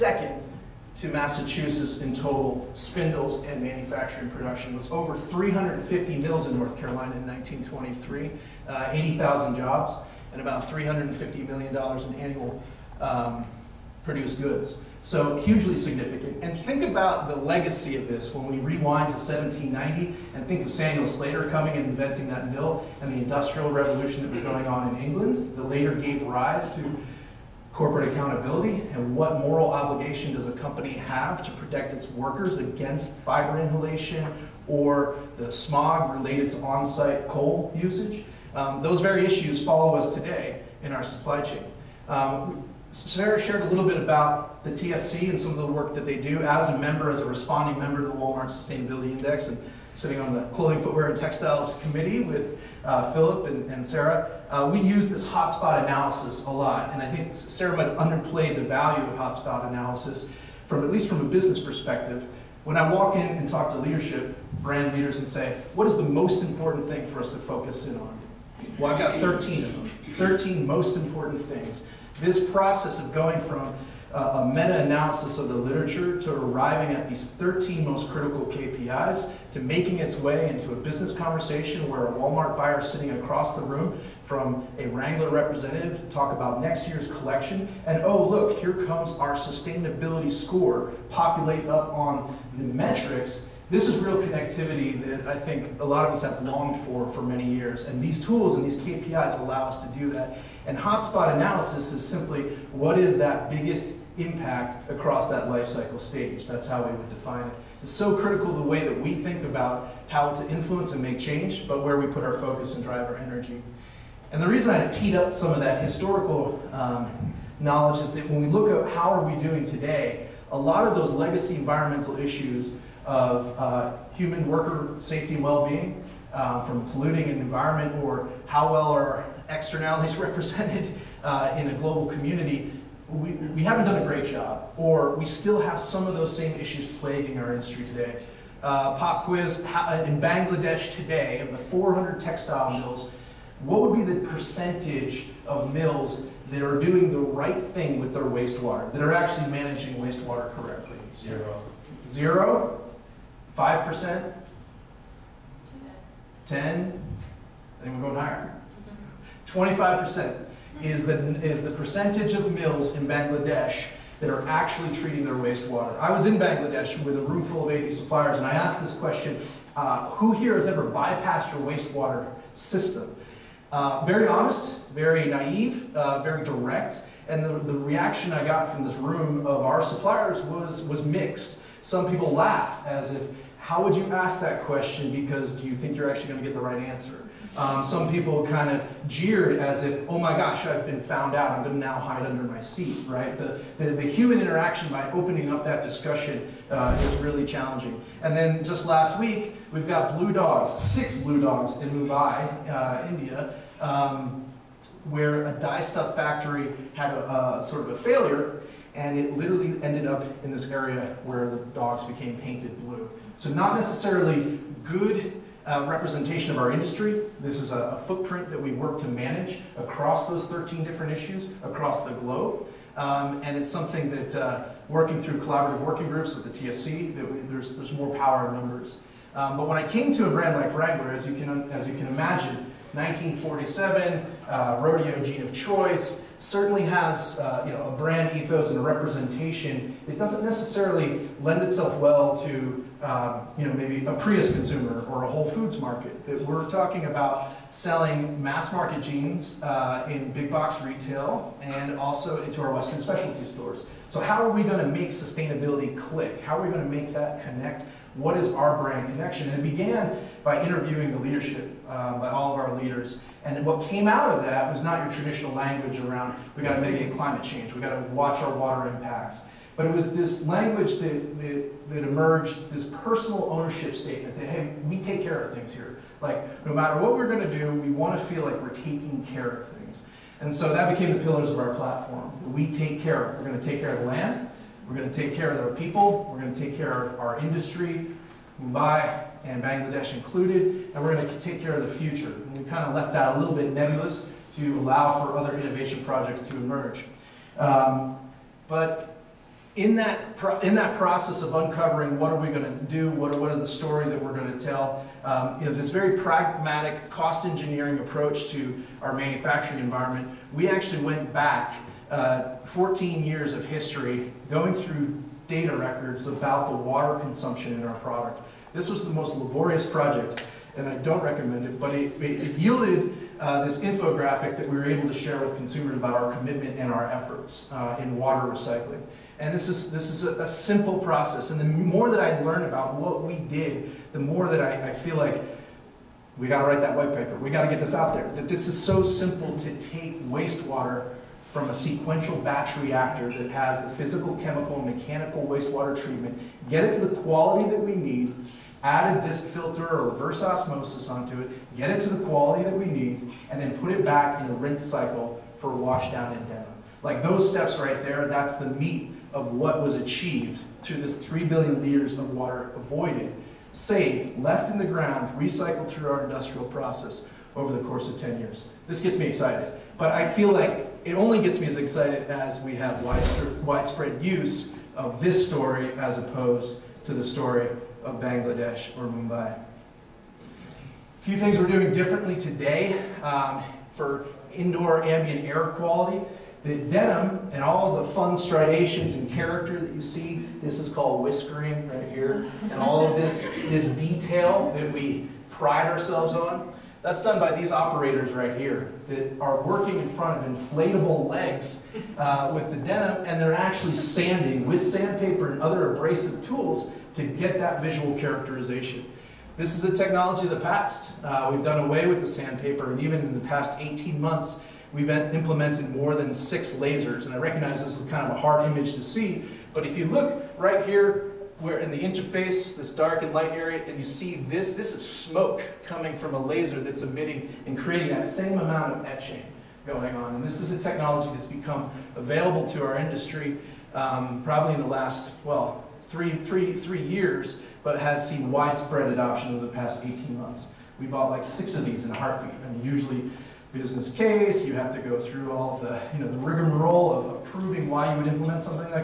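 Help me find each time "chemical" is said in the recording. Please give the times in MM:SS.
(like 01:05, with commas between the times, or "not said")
05:44.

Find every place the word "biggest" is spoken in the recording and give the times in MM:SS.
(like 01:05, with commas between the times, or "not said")
01:43.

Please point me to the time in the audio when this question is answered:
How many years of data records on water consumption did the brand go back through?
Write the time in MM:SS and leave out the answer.
05:12.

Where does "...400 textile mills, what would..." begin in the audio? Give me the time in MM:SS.
02:21.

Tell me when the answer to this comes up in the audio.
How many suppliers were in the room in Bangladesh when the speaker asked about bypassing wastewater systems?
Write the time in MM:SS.
02:47.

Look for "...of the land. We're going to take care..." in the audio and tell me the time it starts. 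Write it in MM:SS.
04:43.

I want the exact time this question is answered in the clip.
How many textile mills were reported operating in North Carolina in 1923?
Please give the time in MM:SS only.
00:04.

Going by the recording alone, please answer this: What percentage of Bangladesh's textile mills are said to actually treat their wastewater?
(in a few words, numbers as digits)
25%.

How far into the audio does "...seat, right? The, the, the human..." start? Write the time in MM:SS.
03:12.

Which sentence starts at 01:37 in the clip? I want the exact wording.
And these tools and these KPIs allow us to do that.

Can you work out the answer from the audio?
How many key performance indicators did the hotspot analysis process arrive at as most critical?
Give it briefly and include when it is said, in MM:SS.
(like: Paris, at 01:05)
13, at 01:17.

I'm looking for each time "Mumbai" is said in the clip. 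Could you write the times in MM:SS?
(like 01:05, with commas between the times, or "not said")
03:21, 04:48, 06:19.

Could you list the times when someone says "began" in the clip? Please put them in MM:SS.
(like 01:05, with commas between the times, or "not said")
04:19.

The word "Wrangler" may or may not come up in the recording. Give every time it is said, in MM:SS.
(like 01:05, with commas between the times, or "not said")
01:24, 03:50.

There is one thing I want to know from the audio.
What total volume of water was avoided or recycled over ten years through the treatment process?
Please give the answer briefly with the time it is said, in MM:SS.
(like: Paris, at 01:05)
3 billion liters, at 06:01.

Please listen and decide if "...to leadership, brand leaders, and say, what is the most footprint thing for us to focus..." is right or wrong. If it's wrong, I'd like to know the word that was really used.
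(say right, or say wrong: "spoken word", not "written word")
wrong: "important", not "footprint".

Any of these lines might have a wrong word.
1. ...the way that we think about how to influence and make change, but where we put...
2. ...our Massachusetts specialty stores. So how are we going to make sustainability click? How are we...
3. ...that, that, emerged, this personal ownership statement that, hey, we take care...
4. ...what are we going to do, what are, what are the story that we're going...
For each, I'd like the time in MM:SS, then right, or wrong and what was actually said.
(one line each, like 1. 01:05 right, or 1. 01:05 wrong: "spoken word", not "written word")
1. 01:48 right
2. 04:12 wrong: "Western", not "Massachusetts"
3. 04:31 right
4. 05:02 right.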